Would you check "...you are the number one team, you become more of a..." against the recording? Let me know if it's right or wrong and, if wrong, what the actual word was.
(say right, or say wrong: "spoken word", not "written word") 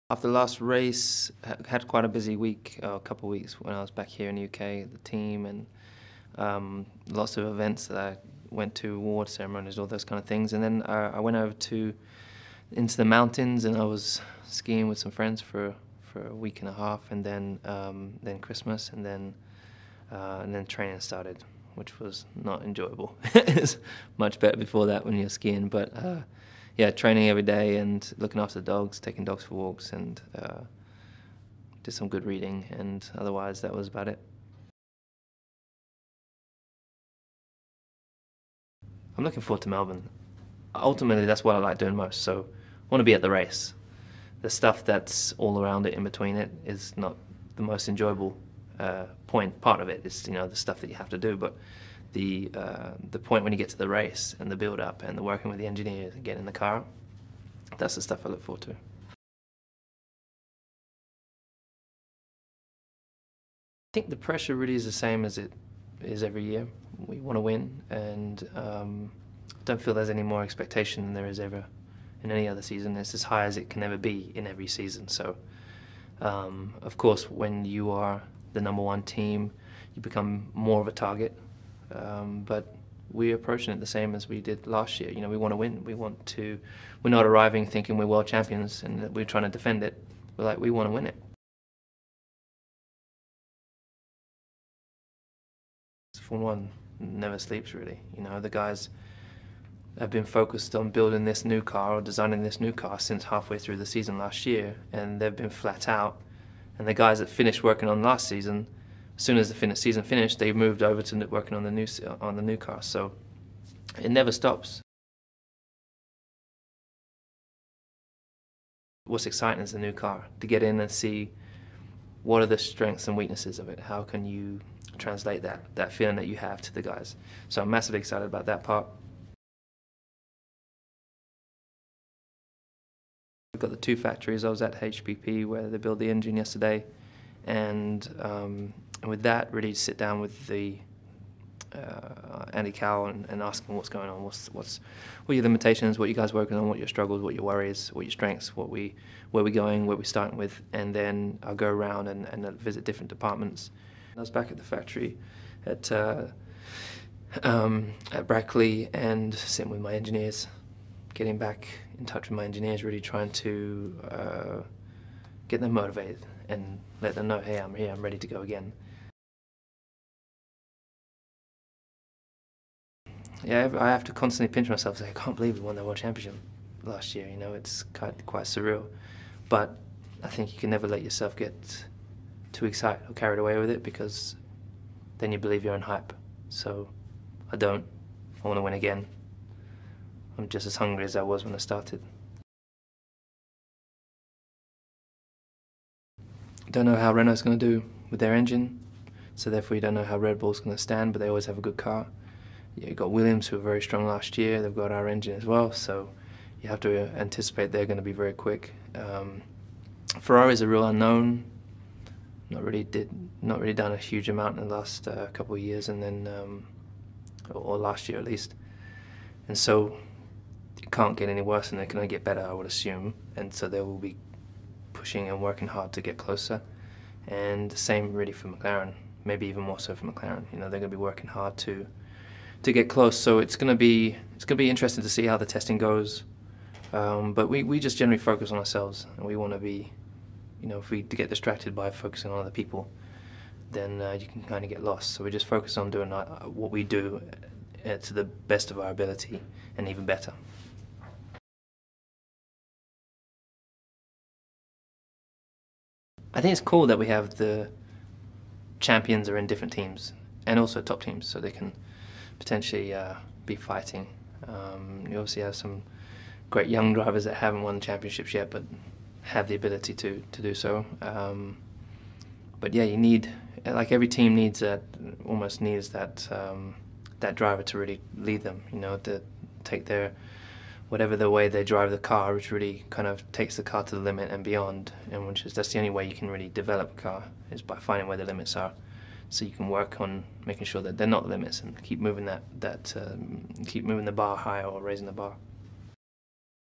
right.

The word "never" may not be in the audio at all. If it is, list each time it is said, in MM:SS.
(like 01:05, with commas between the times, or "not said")
01:36, 01:54, 03:00.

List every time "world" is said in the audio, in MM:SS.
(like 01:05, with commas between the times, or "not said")
01:28, 02:55.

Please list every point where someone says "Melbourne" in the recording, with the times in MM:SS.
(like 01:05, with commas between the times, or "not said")
00:39.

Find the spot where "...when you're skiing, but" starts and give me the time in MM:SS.
00:25.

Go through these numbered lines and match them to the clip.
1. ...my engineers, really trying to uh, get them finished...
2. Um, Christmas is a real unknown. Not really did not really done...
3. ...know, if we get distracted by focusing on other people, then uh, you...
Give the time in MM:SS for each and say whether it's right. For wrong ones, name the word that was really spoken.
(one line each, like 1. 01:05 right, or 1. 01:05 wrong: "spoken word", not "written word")
1. 02:42 wrong: "motivated", not "finished"
2. 03:28 wrong: "Ferrari", not "Christmas"
3. 04:00 right.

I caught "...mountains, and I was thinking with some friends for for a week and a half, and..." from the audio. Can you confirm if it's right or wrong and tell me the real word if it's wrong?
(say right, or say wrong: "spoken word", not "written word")
wrong: "skiing", not "thinking".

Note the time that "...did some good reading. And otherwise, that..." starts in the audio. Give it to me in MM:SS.
00:31.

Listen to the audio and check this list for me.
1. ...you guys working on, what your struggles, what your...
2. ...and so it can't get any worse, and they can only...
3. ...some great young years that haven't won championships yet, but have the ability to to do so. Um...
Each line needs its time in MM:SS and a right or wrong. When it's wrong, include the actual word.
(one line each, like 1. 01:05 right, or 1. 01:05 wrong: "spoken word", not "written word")
1. 02:26 right
2. 03:39 right
3. 04:25 wrong: "drivers", not "years".